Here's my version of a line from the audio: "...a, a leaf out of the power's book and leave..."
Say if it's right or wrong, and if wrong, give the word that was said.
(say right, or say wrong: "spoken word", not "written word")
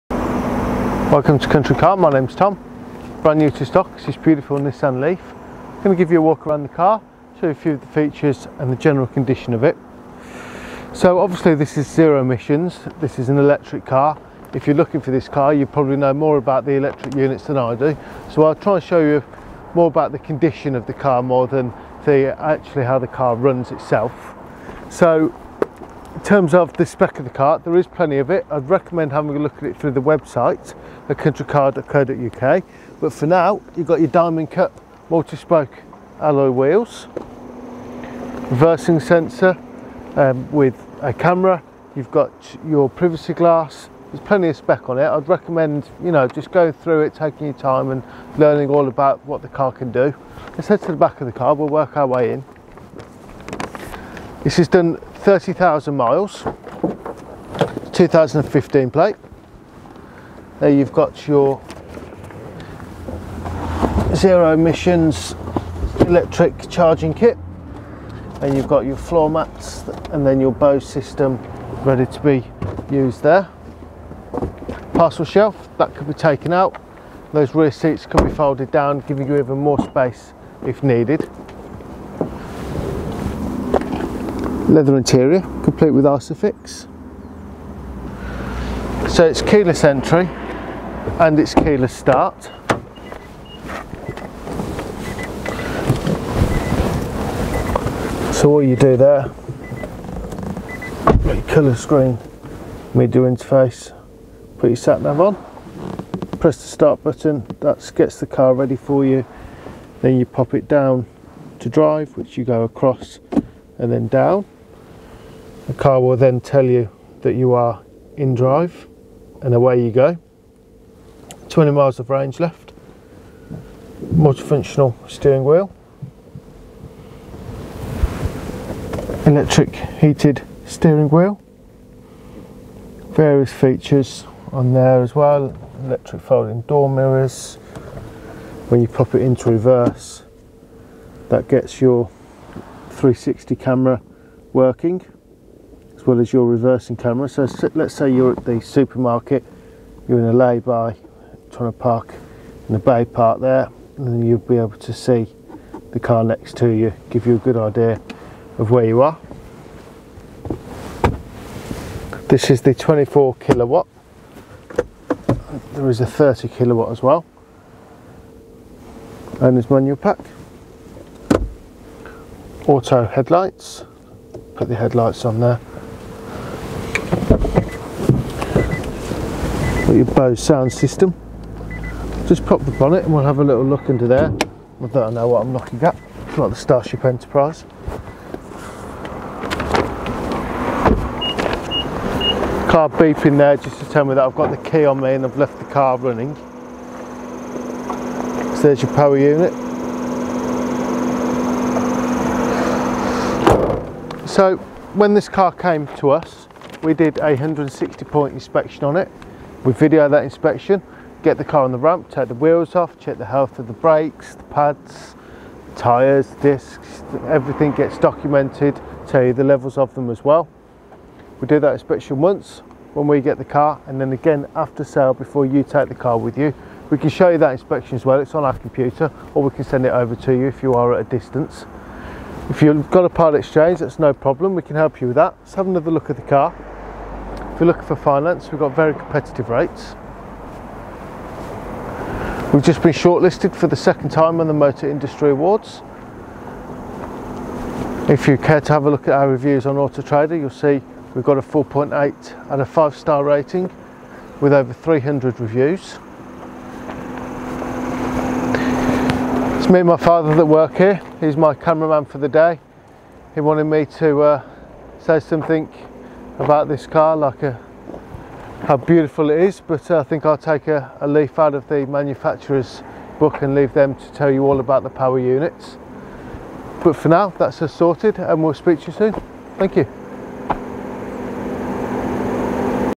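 wrong: "manufacturer", not "power".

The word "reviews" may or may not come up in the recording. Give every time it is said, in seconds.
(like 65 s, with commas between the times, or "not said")
249 s, 255 s.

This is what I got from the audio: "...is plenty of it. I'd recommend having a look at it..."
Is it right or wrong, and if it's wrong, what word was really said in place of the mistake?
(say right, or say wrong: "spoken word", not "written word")
right.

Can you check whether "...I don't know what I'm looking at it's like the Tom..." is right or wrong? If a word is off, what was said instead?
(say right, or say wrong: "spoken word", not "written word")
wrong: "Starship", not "Tom".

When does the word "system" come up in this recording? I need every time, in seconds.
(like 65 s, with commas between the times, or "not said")
70 s, 180 s.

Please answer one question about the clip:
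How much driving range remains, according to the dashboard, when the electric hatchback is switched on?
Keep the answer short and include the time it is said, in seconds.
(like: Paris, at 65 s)
20 miles, at 121 s.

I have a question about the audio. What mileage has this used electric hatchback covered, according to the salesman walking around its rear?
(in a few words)
30,000 miles.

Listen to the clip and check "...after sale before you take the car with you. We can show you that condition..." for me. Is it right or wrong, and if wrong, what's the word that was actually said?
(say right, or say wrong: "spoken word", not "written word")
wrong: "inspection", not "condition".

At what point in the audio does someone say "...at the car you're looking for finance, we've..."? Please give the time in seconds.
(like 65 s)
236 s.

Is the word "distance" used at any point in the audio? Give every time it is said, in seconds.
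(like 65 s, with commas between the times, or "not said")
231 s.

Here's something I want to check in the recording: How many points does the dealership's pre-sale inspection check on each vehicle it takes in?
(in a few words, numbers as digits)
160.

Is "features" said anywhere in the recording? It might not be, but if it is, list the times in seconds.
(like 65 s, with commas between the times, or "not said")
7 s, 133 s.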